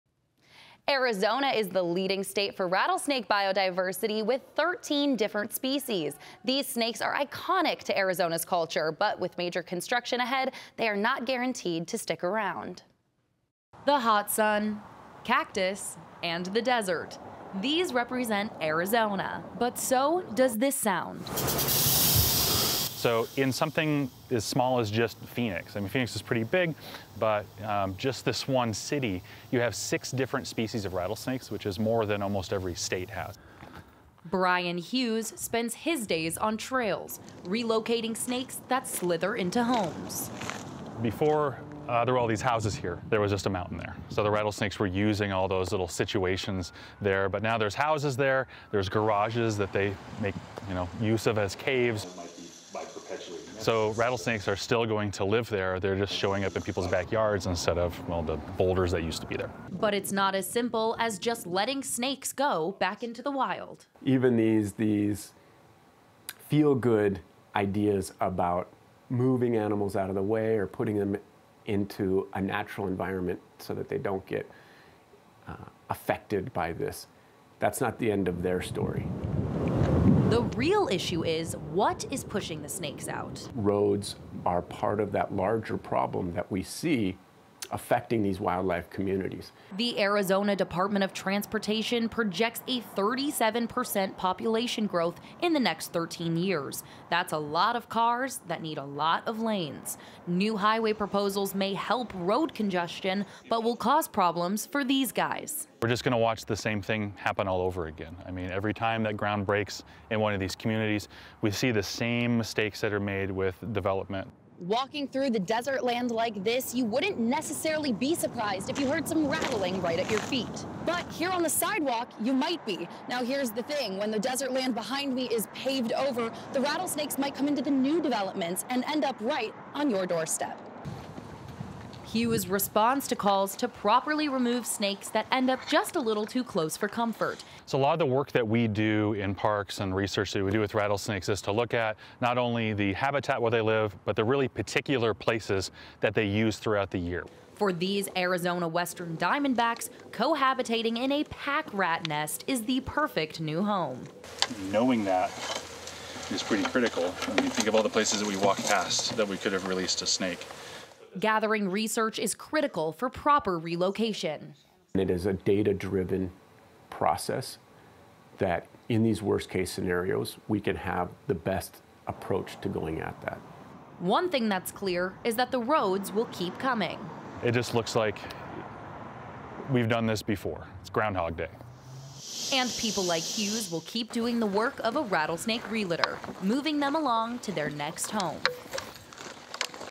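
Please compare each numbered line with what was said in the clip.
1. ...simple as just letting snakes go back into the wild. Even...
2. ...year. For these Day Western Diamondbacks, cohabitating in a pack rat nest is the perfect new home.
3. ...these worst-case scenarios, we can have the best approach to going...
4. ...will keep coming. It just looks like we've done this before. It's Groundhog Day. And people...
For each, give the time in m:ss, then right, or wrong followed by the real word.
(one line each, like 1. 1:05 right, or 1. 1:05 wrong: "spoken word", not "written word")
1. 1:00 right
2. 2:26 wrong: "Arizona", not "Day"
3. 2:49 right
4. 2:56 right.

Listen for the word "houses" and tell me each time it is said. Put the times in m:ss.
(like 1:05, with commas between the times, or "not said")
0:42, 0:47.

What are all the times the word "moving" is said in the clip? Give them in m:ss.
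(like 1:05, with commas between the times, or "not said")
1:09, 3:06.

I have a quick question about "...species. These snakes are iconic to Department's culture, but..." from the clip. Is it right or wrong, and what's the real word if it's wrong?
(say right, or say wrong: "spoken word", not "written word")
wrong: "Arizona", not "Department".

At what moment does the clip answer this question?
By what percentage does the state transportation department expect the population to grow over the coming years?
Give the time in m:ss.
1:32.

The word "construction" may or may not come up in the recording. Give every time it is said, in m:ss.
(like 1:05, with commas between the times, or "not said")
0:09.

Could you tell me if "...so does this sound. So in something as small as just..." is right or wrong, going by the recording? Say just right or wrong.
right.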